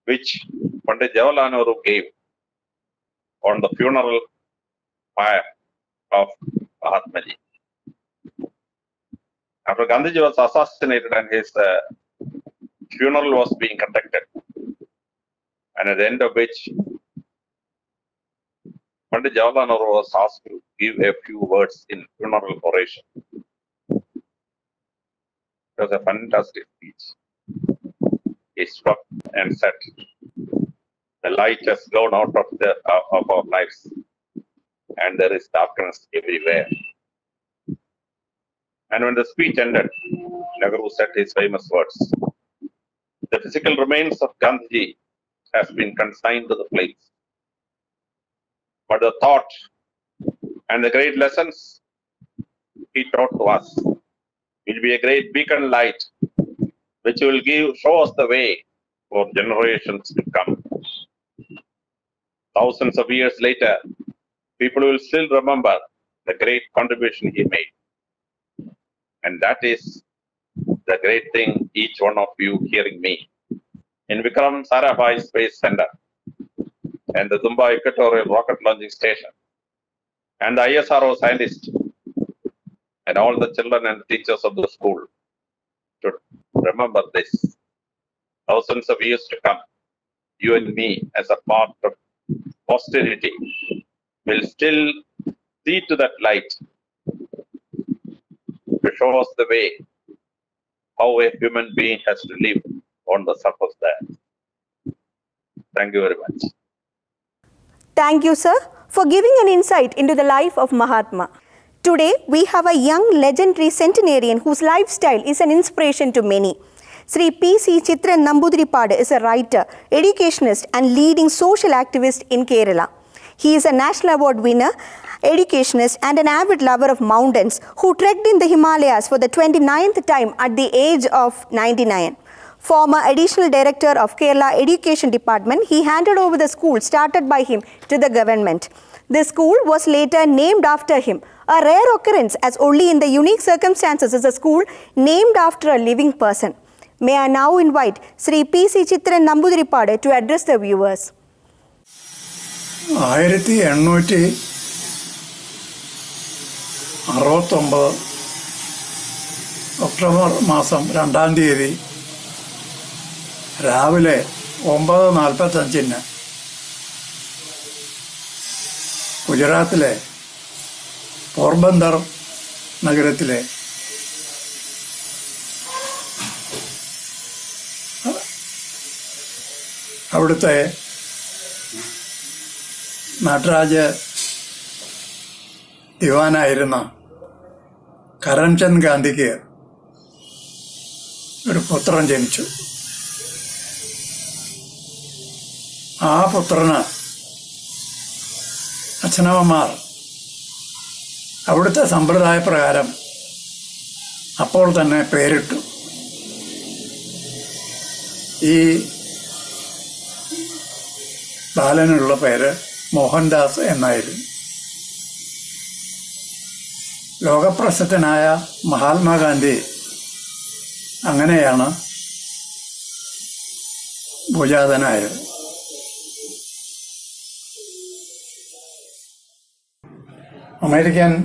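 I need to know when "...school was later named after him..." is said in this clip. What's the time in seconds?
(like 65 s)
139 s.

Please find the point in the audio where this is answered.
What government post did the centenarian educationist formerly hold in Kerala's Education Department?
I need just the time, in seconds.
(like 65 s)
133 s.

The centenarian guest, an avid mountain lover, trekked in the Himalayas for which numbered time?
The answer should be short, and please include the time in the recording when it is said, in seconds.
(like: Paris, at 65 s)
29th, at 129 s.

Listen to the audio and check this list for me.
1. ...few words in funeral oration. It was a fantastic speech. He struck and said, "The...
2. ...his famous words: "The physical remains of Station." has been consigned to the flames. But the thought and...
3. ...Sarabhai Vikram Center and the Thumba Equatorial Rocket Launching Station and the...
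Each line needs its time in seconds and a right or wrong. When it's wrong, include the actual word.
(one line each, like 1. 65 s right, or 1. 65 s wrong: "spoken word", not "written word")
1. 21 s right
2. 41 s wrong: "Gandhi", not "Station"
3. 74 s wrong: "Space", not "Vikram".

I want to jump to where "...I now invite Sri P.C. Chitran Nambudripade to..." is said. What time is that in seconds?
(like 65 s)
147 s.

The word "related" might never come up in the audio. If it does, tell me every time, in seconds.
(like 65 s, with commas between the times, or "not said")
not said.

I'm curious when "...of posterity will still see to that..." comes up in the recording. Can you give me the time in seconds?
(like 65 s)
91 s.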